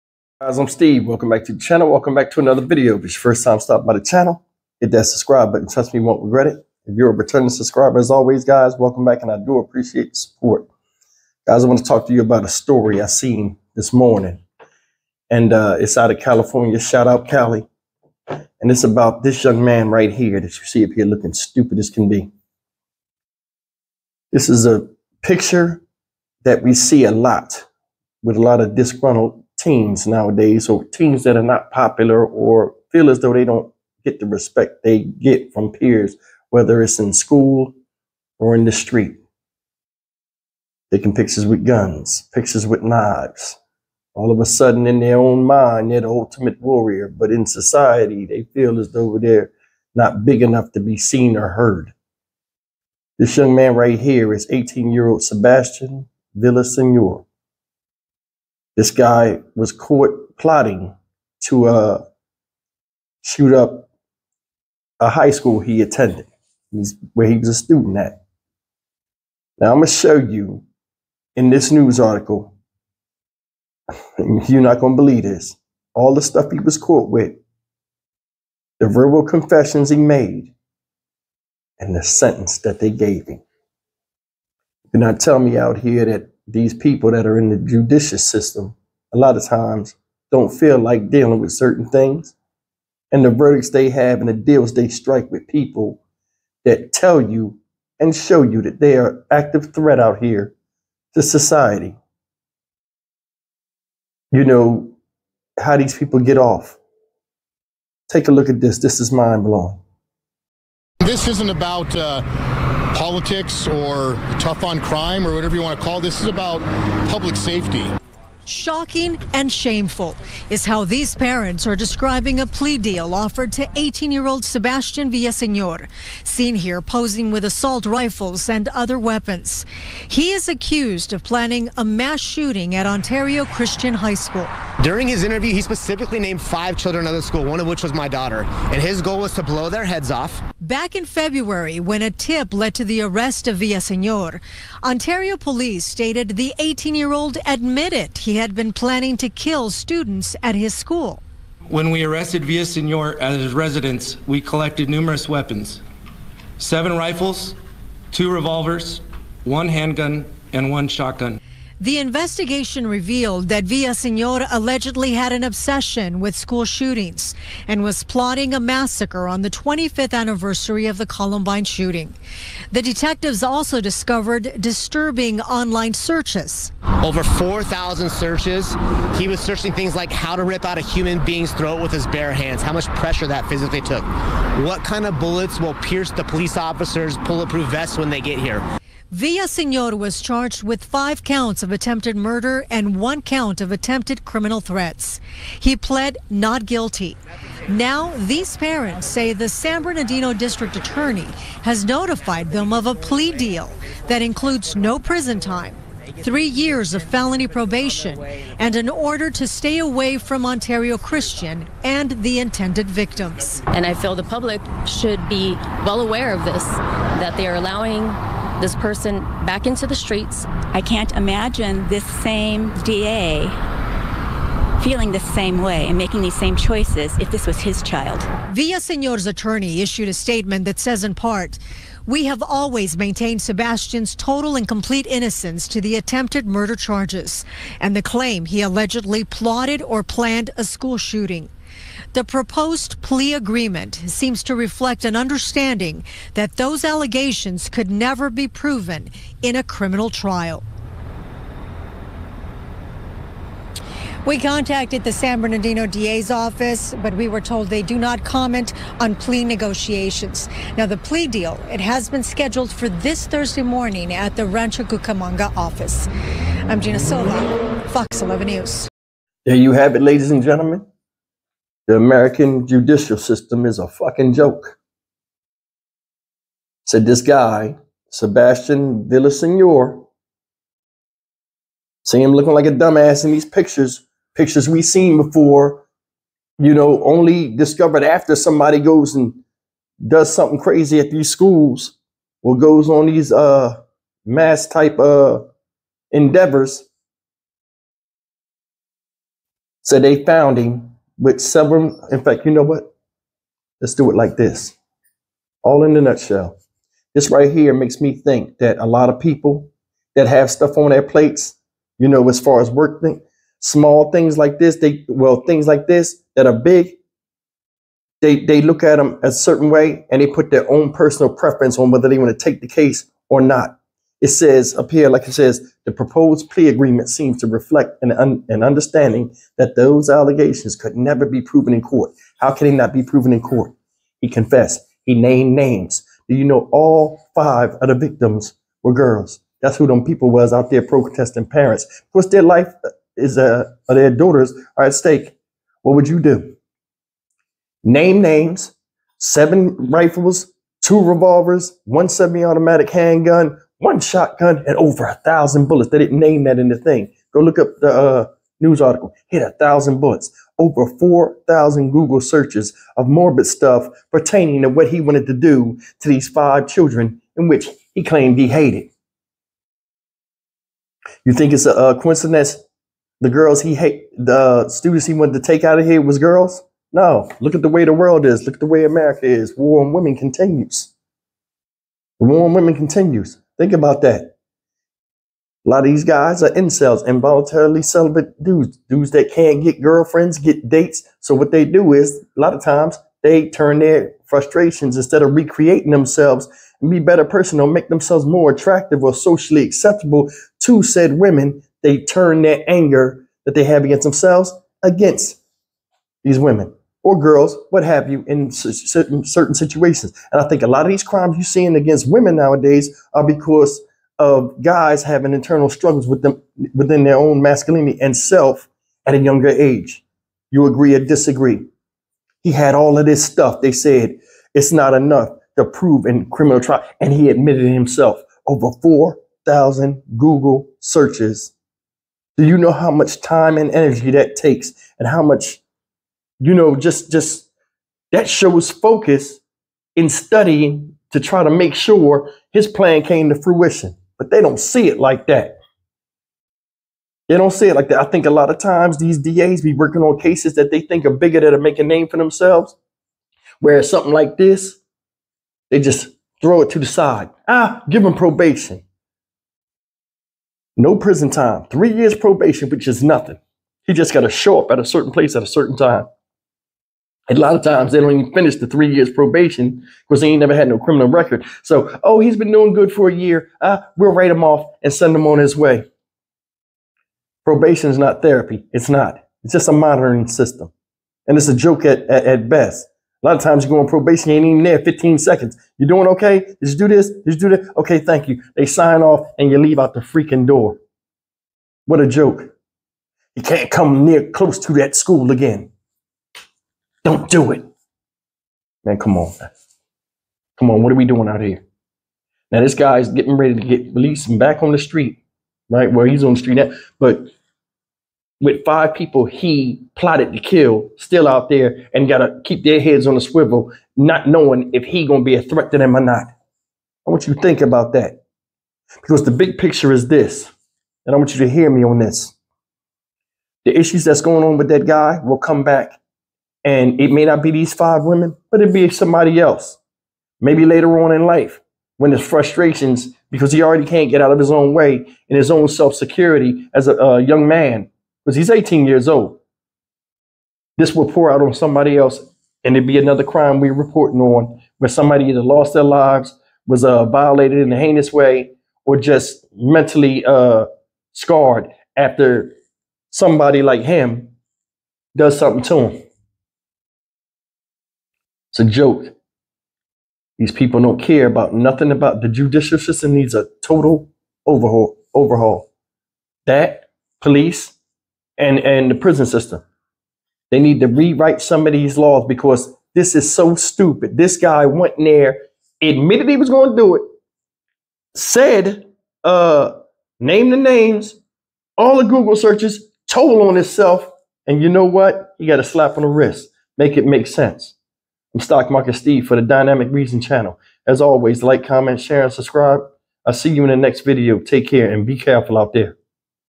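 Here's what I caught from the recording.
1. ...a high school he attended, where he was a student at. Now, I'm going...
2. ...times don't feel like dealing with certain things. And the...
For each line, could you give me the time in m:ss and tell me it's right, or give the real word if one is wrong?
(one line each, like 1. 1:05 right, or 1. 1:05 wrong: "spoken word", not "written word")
1. 1:04 right
2. 1:29 right.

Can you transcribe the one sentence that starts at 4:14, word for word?
We contacted the San Bernardino DA's office, but we were told they do not comment on plea negotiations.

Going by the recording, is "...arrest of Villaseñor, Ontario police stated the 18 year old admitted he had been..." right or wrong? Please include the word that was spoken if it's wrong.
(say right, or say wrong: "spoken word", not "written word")
right.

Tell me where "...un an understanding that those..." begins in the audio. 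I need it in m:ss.
5:28.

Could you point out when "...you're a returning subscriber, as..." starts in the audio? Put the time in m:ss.
0:06.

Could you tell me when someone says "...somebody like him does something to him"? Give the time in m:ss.
9:13.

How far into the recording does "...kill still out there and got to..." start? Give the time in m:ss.
8:30.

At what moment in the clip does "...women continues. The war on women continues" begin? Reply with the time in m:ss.
6:19.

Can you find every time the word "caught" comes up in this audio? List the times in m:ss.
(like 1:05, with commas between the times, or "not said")
0:59, 1:16.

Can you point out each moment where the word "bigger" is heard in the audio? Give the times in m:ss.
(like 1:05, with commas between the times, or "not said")
7:31.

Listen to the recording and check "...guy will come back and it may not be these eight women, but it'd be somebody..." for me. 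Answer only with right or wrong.
wrong.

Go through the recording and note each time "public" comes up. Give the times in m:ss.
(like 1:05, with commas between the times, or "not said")
1:57, 3:34.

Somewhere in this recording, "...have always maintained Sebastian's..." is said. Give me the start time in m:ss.
3:52.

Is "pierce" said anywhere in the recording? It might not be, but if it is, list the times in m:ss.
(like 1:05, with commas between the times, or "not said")
3:05.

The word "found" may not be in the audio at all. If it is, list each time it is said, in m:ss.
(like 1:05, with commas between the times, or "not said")
5:00.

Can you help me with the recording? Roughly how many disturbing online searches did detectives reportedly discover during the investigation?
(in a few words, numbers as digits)
4,000.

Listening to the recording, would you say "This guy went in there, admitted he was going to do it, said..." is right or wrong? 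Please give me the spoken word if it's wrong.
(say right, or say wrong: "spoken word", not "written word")
right.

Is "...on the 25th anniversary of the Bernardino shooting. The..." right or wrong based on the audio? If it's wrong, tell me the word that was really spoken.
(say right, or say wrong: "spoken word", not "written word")
wrong: "Columbine", not "Bernardino".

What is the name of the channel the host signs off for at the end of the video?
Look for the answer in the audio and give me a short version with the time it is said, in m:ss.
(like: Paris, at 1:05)
Dynamic Reason, at 9:49.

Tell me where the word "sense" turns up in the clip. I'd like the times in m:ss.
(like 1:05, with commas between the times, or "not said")
9:47.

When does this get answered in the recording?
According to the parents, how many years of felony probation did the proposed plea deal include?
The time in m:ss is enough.
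3:26.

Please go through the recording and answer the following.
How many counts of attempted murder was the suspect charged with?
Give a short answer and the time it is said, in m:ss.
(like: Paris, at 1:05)
5, at 3:10.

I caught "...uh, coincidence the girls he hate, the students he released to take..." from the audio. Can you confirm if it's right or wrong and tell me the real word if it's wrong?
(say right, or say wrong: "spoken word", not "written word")
wrong: "wanted", not "released".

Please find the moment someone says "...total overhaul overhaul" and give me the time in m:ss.
9:23.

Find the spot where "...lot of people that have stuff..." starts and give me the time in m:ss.
5:08.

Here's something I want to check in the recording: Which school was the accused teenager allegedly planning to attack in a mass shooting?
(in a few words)
Ontario Christian High School.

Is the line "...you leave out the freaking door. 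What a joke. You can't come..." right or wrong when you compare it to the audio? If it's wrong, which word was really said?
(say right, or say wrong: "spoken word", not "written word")
right.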